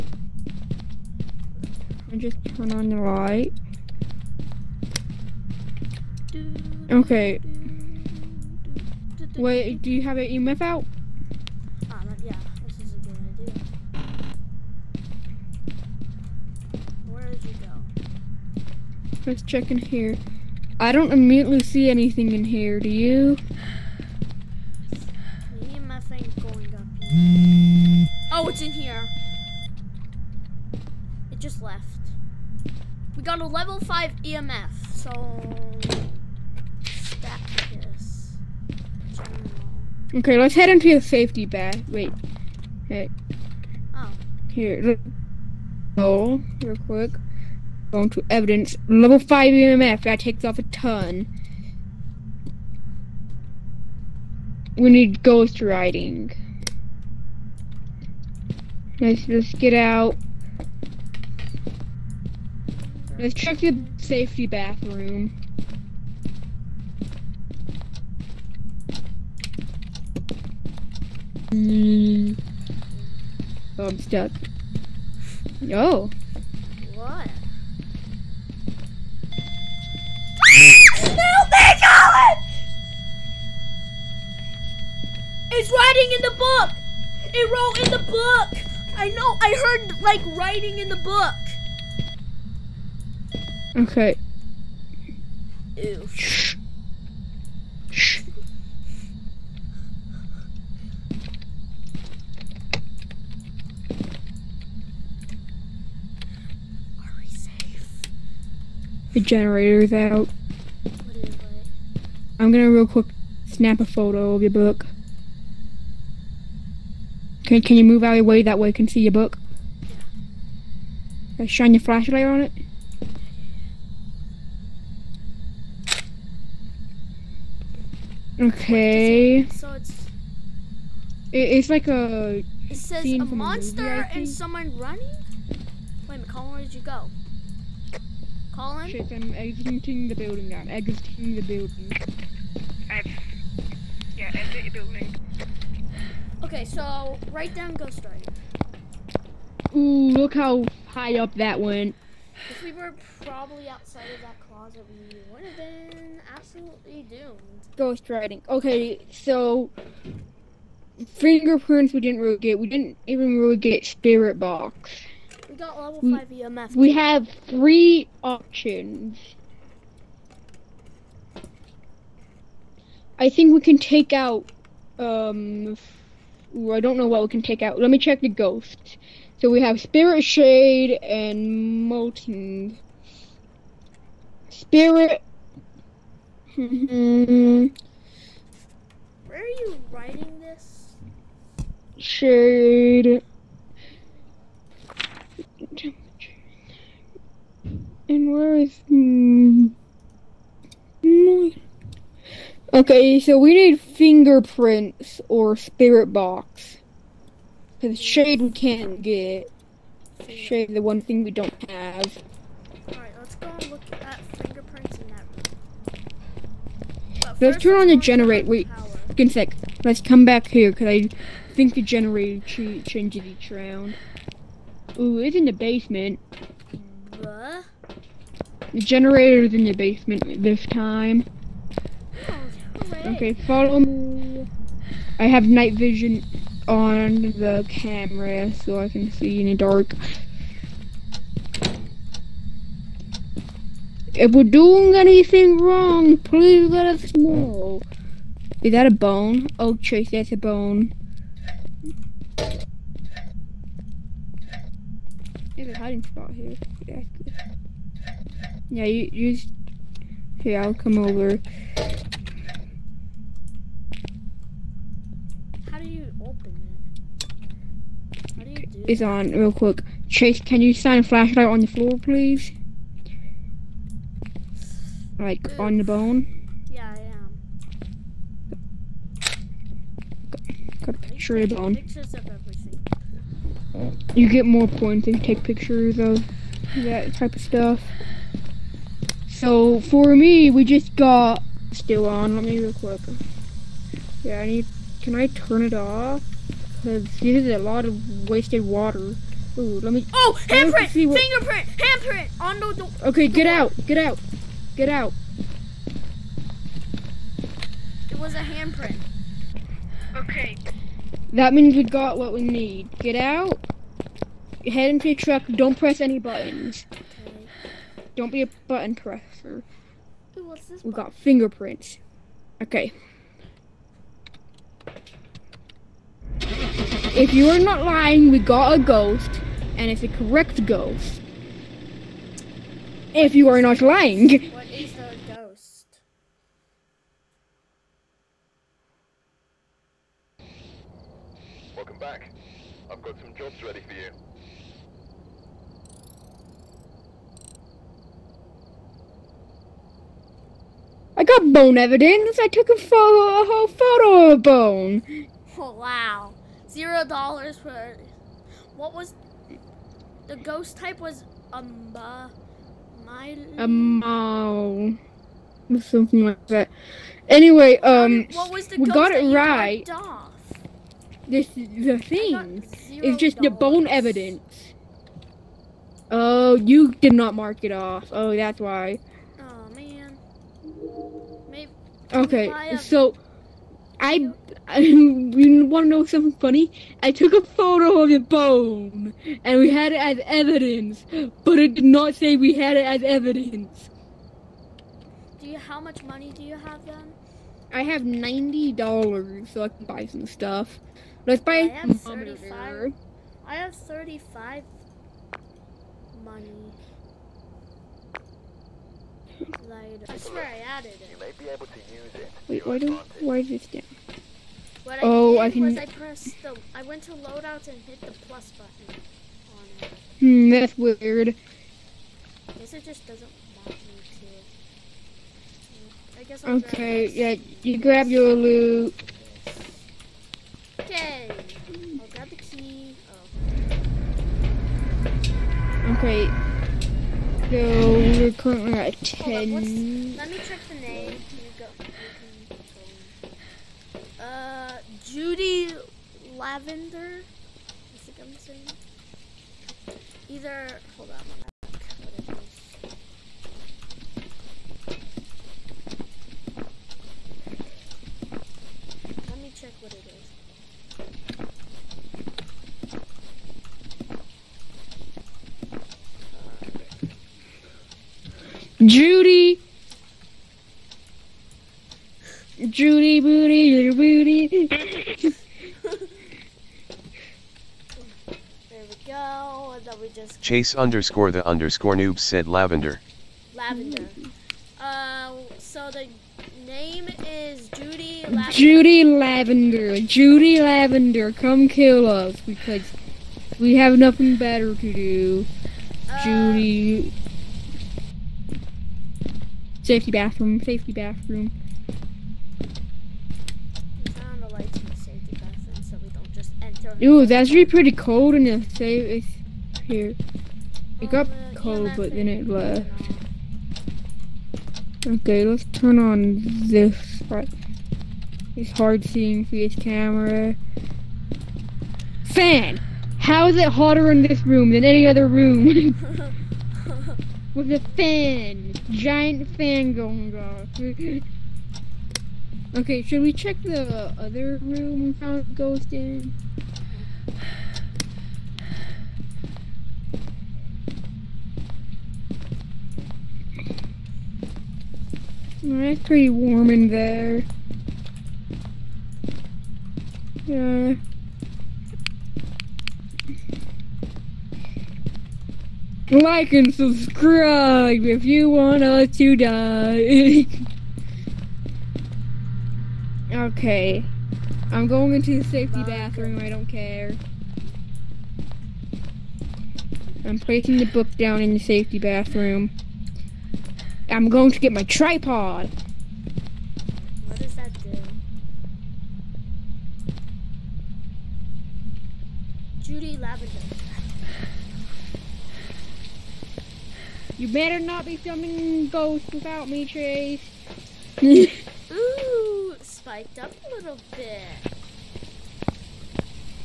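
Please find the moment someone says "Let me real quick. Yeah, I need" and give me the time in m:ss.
4:52.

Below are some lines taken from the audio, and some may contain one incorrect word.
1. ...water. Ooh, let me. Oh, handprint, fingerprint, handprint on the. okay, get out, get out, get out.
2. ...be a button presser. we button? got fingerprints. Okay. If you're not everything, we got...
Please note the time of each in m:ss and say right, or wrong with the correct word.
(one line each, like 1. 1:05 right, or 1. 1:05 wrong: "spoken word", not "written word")
1. 4:58 right
2. 5:18 wrong: "lying", not "everything".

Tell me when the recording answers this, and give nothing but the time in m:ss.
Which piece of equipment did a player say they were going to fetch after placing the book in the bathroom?
9:34.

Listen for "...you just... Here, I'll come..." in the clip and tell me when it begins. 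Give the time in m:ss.
4:19.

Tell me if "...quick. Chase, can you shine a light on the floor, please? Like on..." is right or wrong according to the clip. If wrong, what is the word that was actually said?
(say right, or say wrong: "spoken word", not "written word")
wrong: "flashlight", not "light".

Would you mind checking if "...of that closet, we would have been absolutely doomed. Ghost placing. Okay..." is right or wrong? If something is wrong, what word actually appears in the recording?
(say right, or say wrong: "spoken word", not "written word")
wrong: "writing", not "placing".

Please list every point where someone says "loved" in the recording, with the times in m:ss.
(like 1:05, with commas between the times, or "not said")
not said.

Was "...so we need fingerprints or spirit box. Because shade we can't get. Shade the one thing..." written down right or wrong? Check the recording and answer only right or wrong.
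right.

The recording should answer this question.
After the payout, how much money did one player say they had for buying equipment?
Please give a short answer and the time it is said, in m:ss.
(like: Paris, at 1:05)
90 dollars, at 6:38.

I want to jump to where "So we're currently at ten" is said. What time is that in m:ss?
7:17.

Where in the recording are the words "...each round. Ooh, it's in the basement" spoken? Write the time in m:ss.
3:43.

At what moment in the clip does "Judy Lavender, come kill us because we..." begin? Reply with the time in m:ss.
8:10.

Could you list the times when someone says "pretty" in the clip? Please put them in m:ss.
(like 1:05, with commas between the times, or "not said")
8:27, 9:06.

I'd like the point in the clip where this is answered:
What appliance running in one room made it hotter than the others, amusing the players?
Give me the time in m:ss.
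8:48.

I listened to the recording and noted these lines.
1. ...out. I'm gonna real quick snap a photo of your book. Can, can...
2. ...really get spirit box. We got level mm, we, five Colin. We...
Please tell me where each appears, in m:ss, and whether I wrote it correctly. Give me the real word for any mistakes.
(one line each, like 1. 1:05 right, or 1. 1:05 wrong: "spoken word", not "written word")
1. 1:49 right
2. 2:43 wrong: "EMF", not "Colin".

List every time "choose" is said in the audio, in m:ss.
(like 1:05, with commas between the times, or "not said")
not said.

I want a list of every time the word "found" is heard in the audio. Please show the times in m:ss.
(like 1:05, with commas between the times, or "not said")
8:55.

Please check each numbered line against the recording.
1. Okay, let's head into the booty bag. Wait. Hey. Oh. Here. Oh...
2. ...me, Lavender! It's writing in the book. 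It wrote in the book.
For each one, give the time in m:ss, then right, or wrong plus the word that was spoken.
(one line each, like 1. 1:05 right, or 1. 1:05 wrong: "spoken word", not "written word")
1. 0:40 wrong: "safety", not "booty"
2. 1:21 wrong: "Colin", not "Lavender".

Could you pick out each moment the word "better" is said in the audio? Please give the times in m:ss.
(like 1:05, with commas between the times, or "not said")
8:14, 9:47.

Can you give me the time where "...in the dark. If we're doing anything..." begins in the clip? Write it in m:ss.
3:59.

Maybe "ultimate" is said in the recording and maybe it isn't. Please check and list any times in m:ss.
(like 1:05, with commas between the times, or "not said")
not said.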